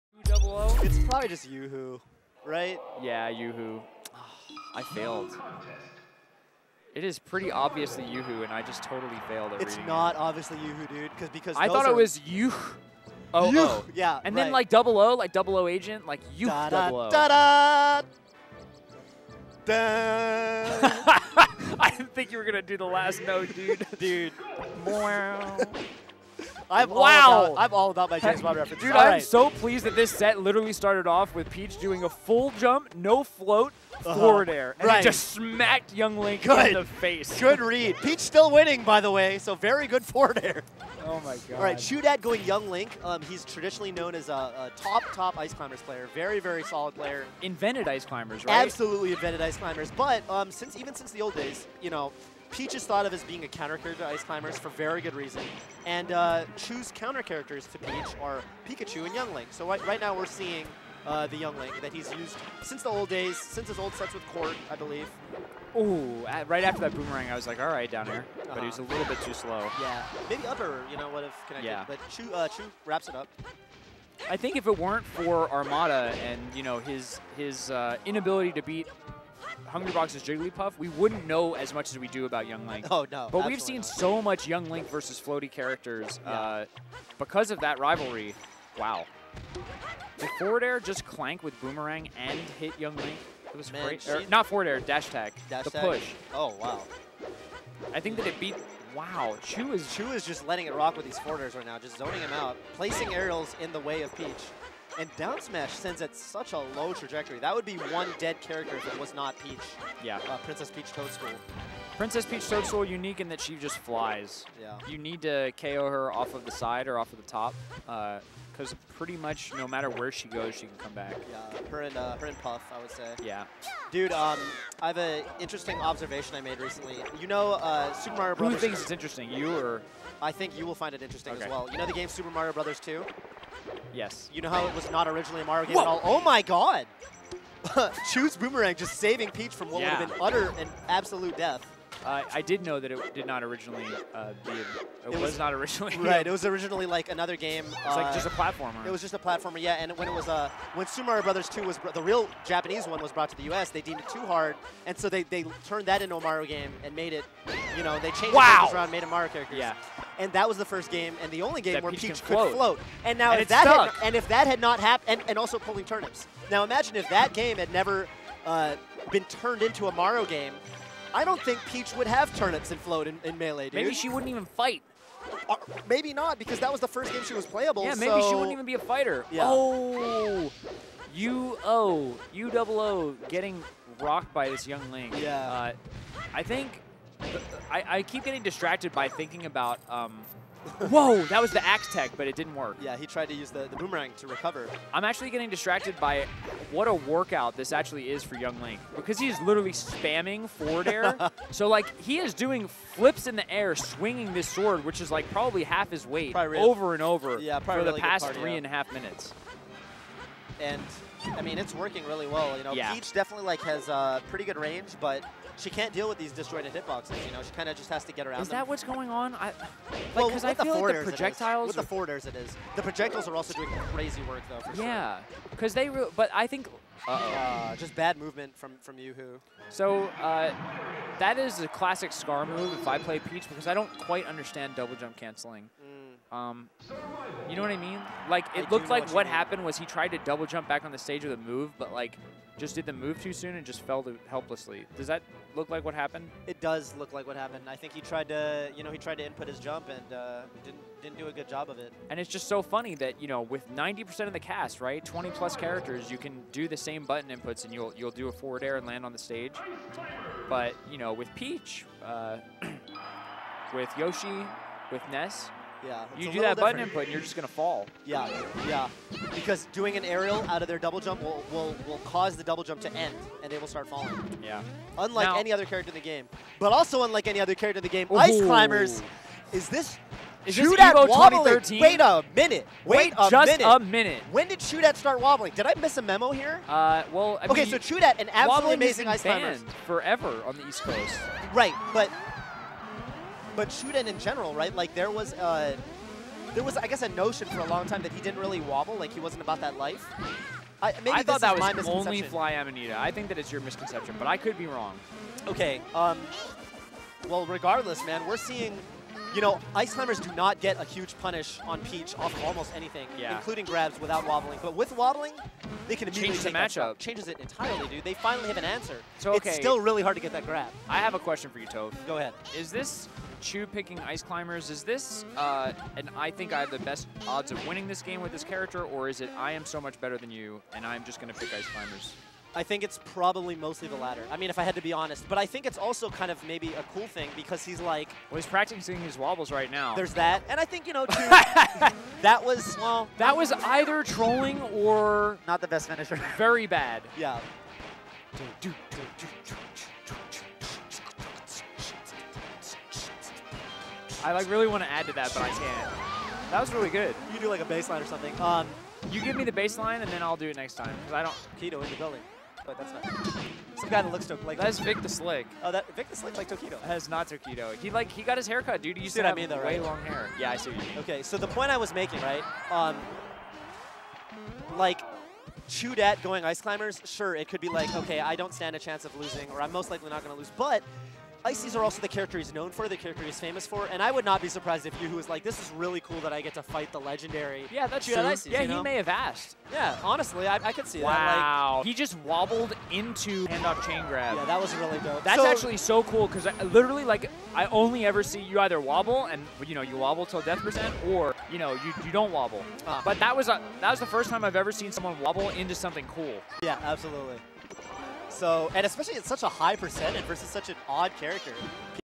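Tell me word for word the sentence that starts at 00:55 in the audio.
And uh, choose counter characters to Peach are Pikachu and Young Link.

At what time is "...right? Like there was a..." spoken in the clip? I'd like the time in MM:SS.
04:54.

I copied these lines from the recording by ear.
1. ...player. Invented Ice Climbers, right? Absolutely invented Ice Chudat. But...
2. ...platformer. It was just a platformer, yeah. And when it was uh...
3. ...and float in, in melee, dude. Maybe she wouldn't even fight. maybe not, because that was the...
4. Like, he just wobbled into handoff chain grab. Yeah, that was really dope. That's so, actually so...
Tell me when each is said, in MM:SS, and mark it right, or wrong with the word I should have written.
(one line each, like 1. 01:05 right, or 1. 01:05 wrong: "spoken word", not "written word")
1. 00:46 wrong: "Climbers", not "Chudat"
2. 02:28 right
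3. 02:52 right
4. 06:31 right.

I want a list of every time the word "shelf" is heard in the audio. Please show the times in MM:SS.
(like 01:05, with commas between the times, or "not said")
not said.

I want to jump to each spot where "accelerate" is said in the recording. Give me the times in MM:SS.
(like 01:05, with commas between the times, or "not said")
not said.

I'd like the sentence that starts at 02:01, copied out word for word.
Yeah, her and, uh, her and Puff, I would say.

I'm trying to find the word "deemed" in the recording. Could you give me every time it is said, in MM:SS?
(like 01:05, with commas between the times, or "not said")
02:33.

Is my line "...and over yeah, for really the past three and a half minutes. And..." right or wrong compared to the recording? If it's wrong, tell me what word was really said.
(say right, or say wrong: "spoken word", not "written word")
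right.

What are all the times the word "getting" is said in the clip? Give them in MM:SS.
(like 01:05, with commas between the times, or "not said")
03:03, 03:08, 03:15.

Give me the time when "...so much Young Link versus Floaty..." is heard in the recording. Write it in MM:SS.
01:23.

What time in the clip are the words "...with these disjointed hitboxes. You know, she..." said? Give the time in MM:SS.
03:36.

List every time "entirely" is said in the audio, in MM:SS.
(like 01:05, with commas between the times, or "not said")
05:17.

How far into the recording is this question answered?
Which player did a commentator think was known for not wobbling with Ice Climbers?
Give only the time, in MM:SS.
05:02.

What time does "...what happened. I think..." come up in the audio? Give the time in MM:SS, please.
04:07.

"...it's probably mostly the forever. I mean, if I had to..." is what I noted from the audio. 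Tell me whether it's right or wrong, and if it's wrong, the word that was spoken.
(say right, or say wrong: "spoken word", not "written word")
wrong: "latter", not "forever".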